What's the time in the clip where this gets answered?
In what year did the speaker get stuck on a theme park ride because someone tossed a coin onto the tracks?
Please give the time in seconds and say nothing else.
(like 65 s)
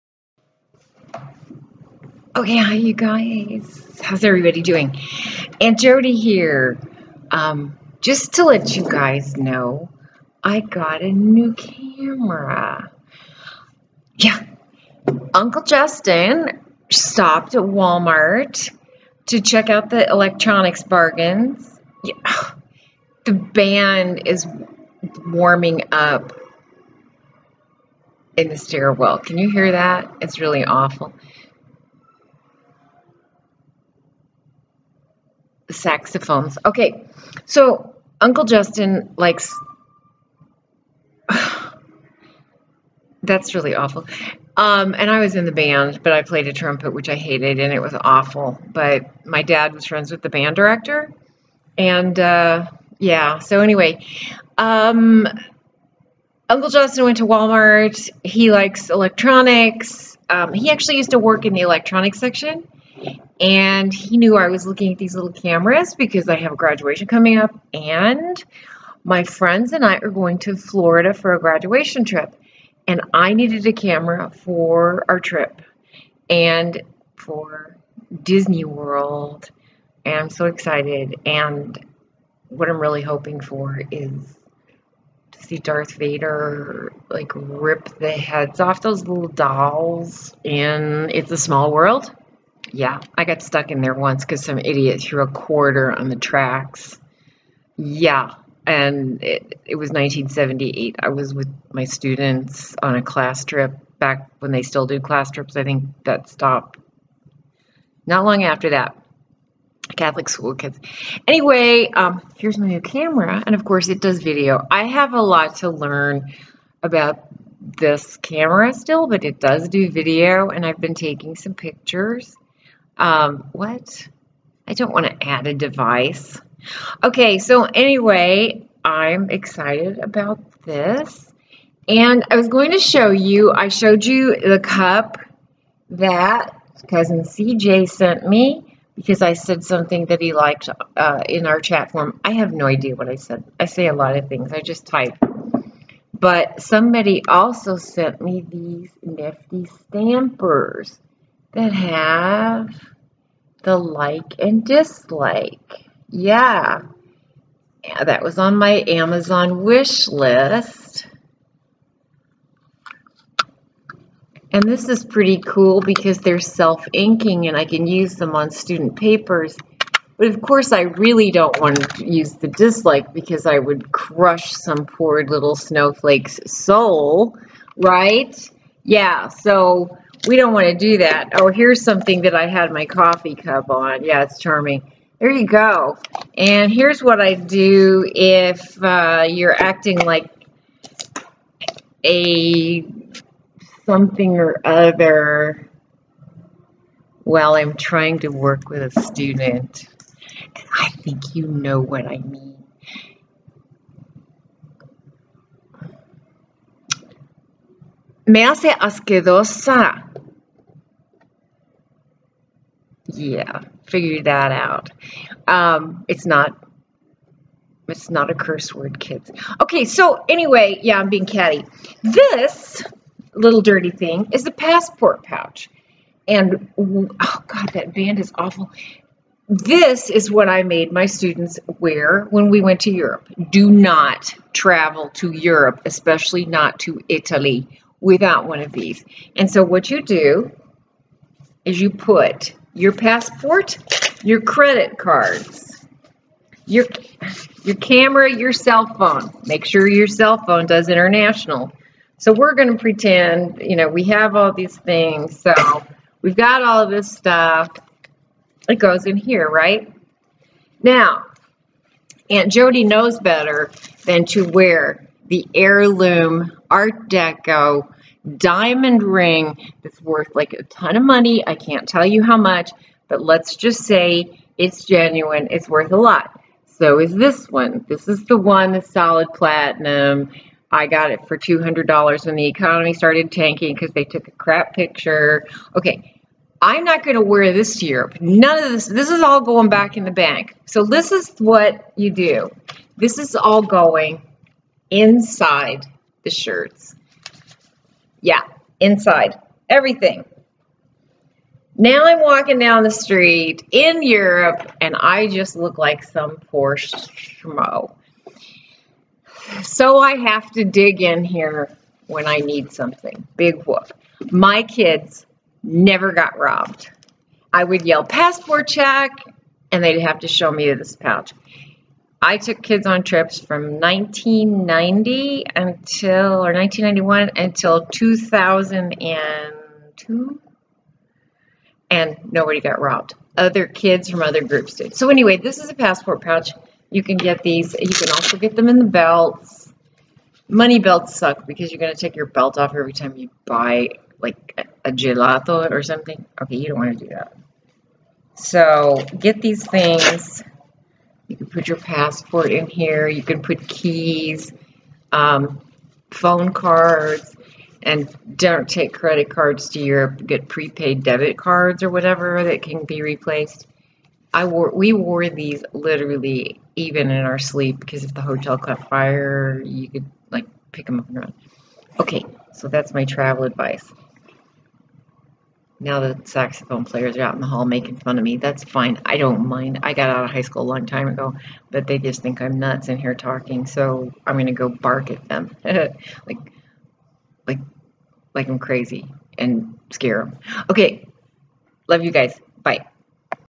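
99 s.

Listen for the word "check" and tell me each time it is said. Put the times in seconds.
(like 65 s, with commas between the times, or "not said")
19 s, 318 s.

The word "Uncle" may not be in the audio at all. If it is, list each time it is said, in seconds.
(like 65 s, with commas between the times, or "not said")
15 s, 38 s, 56 s.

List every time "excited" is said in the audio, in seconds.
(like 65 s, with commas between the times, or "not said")
80 s, 129 s.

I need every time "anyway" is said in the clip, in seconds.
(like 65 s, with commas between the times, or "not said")
53 s, 111 s, 127 s, 220 s, 335 s.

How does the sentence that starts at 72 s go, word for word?
And I needed a camera for our trip and for Disney World.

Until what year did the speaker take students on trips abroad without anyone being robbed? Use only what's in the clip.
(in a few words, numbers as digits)
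2002.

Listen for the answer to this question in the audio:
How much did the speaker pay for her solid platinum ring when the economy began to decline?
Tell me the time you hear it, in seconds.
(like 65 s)
281 s.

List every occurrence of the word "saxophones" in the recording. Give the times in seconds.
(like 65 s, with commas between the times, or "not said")
35 s, 376 s.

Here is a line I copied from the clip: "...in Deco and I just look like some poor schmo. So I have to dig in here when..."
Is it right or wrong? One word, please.
wrong.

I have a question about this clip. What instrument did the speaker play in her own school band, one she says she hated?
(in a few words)
trumpet.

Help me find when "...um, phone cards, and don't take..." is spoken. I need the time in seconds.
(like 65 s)
355 s.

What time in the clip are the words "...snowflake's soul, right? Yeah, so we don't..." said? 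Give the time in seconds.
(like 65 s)
175 s.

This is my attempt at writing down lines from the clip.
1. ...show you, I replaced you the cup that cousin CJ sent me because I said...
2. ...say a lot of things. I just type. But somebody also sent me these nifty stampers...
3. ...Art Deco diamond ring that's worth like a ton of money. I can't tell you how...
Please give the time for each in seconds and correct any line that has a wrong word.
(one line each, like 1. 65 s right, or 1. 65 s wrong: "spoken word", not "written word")
1. 132 s wrong: "showed", not "replaced"
2. 143 s right
3. 266 s right.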